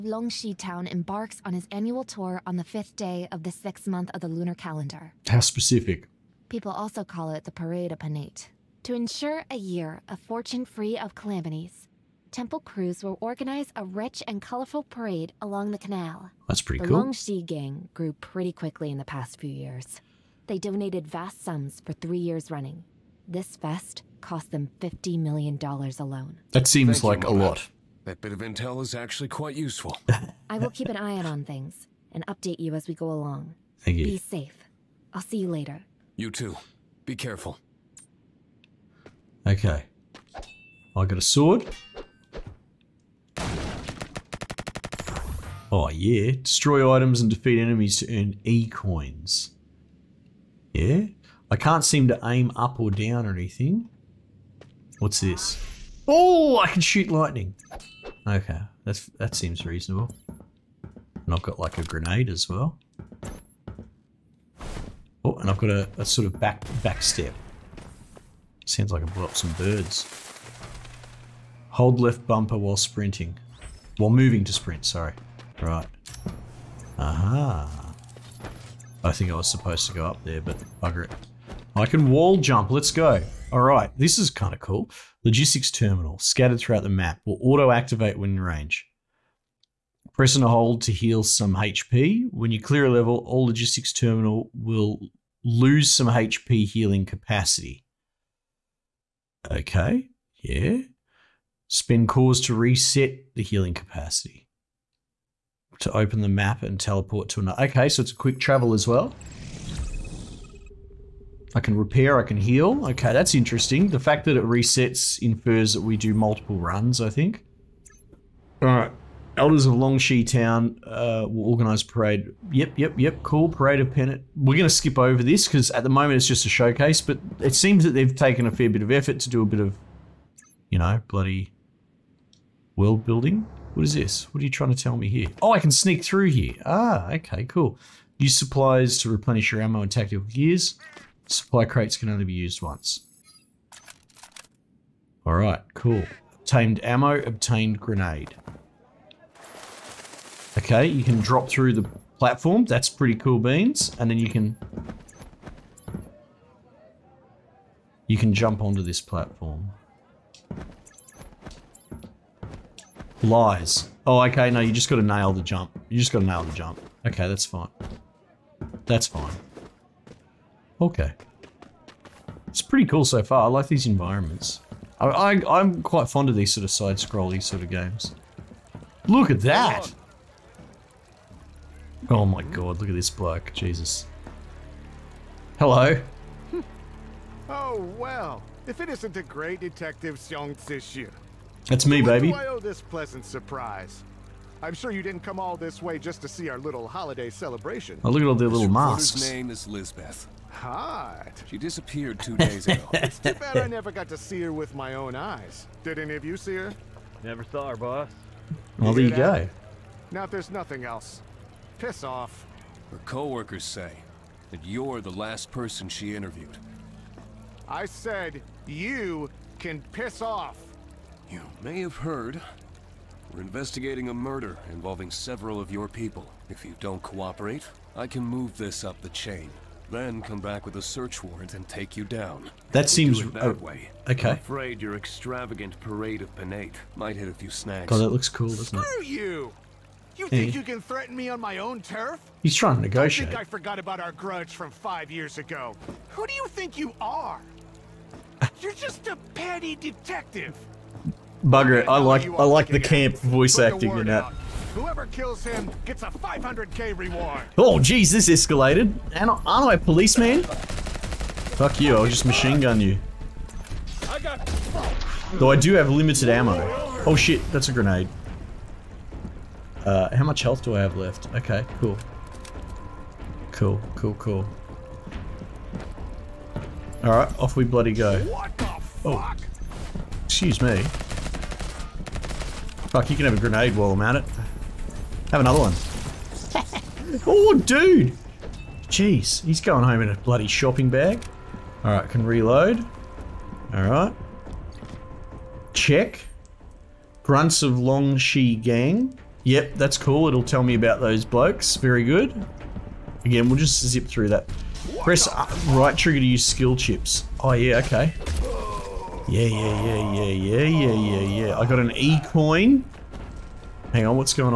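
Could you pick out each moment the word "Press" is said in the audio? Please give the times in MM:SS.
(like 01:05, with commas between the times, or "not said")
01:30, 05:05.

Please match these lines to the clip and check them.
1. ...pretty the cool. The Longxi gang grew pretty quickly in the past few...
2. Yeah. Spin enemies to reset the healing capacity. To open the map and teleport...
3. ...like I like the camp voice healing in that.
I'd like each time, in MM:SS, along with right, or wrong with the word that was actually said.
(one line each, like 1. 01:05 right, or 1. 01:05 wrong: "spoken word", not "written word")
1. 00:16 right
2. 01:40 wrong: "cores", not "enemies"
3. 04:11 wrong: "acting", not "healing".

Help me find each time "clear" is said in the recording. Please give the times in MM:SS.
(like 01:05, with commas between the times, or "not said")
01:32.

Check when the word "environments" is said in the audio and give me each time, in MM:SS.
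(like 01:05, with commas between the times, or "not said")
02:53.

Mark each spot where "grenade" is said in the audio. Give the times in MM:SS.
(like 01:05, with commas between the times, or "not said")
01:01, 02:27, 04:27, 04:43.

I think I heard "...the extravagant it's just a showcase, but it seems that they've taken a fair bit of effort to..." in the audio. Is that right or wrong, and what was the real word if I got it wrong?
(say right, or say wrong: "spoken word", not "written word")
wrong: "moment", not "extravagant".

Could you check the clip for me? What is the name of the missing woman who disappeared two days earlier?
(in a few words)
Lisbeth.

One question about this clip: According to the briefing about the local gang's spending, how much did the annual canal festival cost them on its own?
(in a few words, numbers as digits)
$50 million.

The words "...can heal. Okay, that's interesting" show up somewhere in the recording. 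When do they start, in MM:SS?
01:52.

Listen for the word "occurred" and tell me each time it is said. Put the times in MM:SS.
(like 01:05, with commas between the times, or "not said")
not said.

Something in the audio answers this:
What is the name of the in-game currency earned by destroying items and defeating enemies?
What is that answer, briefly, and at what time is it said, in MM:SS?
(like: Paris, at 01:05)
E-coins, at 00:48.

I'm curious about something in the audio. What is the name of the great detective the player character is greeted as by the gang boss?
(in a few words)
Xiong Zixu.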